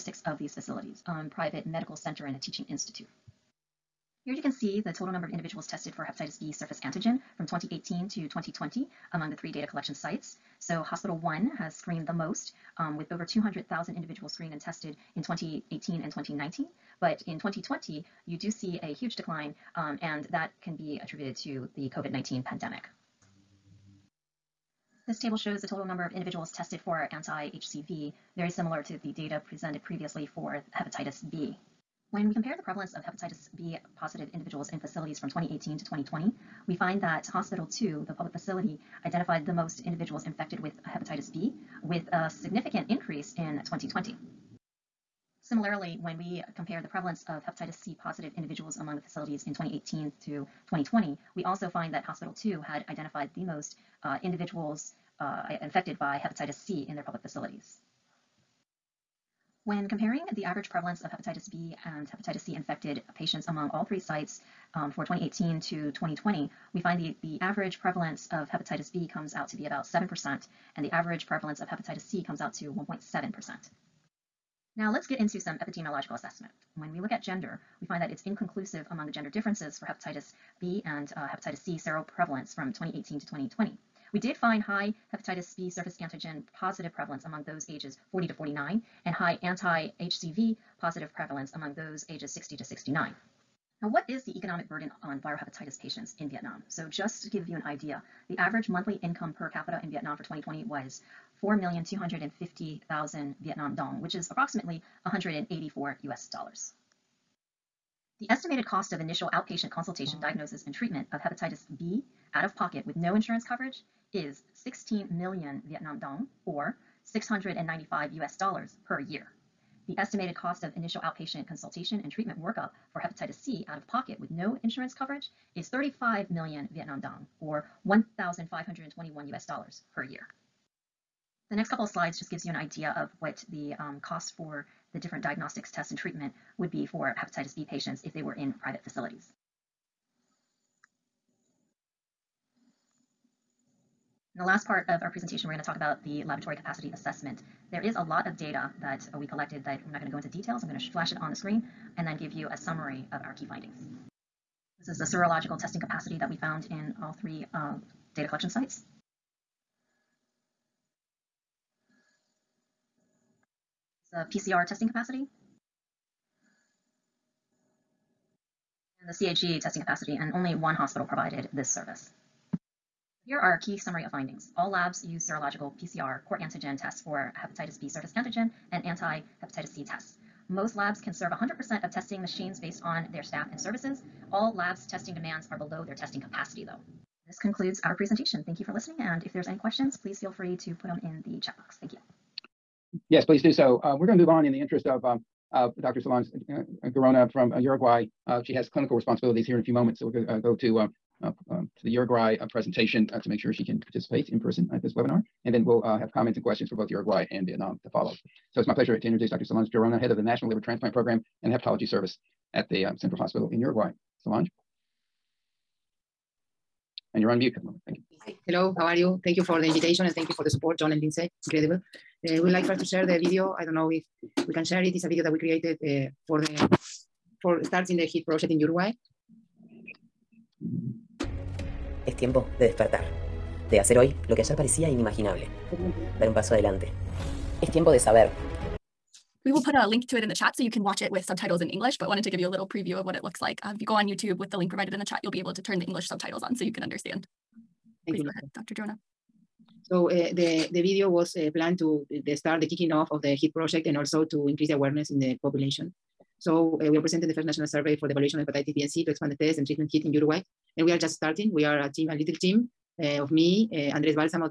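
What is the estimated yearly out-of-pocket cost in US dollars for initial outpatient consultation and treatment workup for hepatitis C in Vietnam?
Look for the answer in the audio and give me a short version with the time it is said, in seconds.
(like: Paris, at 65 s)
$1,521, at 127 s.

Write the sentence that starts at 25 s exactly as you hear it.
This table shows the total number of individuals tested for anti-HCV, very similar to the data presented previously for hepatitis B.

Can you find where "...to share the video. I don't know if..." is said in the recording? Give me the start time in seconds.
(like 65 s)
222 s.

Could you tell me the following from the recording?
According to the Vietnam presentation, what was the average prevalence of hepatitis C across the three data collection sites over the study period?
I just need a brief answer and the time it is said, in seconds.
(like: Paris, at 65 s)
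1.7%, at 72 s.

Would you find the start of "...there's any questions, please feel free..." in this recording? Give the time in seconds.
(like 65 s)
189 s.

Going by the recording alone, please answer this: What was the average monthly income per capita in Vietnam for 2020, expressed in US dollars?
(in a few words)
$184.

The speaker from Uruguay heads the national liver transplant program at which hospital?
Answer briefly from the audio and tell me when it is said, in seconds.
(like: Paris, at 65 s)
Central Hospital, at 212 s.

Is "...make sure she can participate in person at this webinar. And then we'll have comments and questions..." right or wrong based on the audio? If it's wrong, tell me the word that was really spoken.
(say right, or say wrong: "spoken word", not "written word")
right.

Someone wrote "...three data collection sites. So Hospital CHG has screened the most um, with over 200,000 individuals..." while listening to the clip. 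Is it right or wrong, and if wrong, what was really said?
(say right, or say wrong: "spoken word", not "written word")
wrong: "One", not "CHG".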